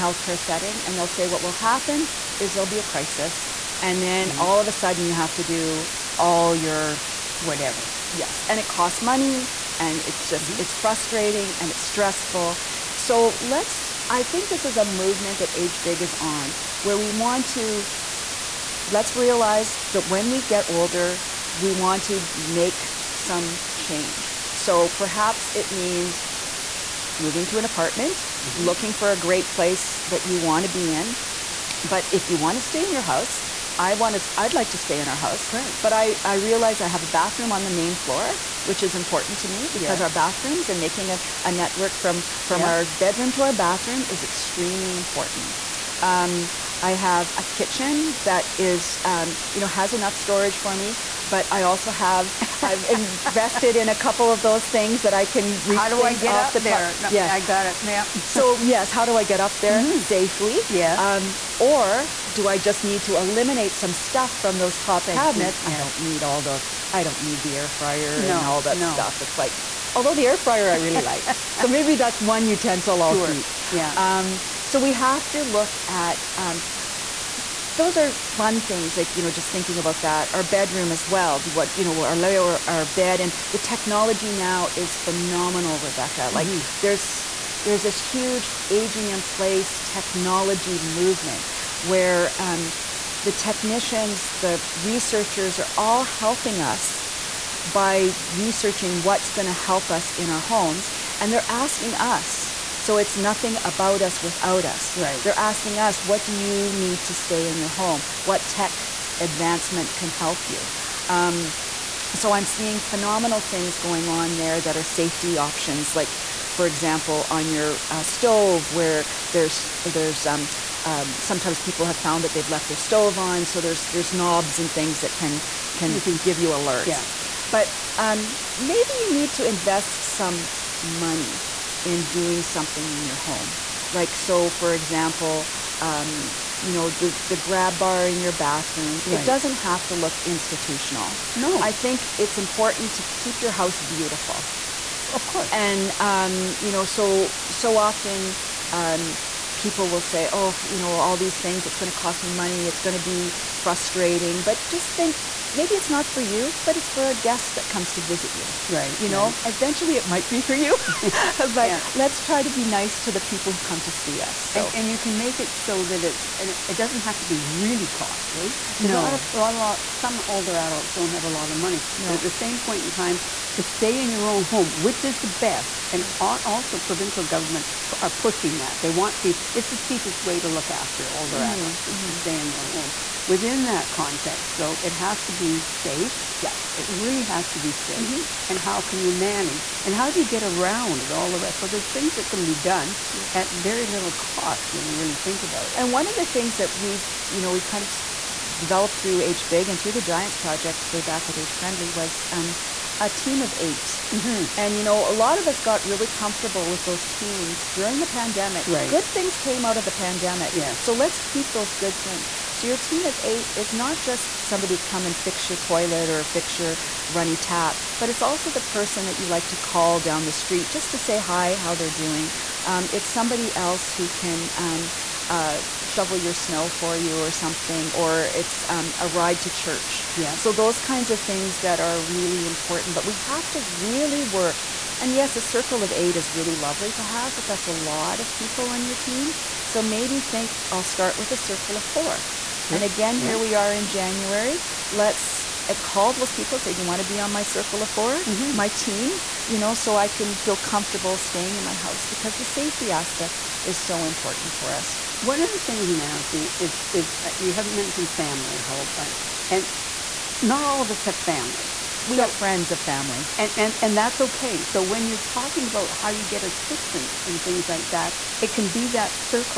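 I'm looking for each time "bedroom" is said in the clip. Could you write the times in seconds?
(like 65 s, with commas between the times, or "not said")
42 s, 80 s.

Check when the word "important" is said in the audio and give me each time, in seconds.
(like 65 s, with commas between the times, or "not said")
38 s, 44 s, 142 s, 232 s, 254 s.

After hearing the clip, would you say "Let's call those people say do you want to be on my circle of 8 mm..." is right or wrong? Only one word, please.
wrong.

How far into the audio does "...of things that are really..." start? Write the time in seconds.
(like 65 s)
231 s.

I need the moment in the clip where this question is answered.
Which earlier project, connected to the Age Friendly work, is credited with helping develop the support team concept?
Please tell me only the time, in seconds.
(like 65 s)
200 s.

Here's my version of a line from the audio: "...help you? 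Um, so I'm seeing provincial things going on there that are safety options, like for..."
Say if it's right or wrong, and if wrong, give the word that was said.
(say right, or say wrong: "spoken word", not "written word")
wrong: "phenomenal", not "provincial".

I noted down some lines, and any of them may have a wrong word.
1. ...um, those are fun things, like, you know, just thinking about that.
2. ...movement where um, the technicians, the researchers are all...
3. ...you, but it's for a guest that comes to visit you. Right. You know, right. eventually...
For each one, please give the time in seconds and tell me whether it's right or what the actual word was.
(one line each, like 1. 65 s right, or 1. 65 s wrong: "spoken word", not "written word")
1. 76 s right
2. 90 s right
3. 156 s right.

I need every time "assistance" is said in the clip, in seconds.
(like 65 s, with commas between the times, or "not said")
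266 s.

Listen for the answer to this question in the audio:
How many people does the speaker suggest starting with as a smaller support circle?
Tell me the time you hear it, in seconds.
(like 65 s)
241 s.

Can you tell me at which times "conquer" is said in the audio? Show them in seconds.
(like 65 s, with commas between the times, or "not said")
not said.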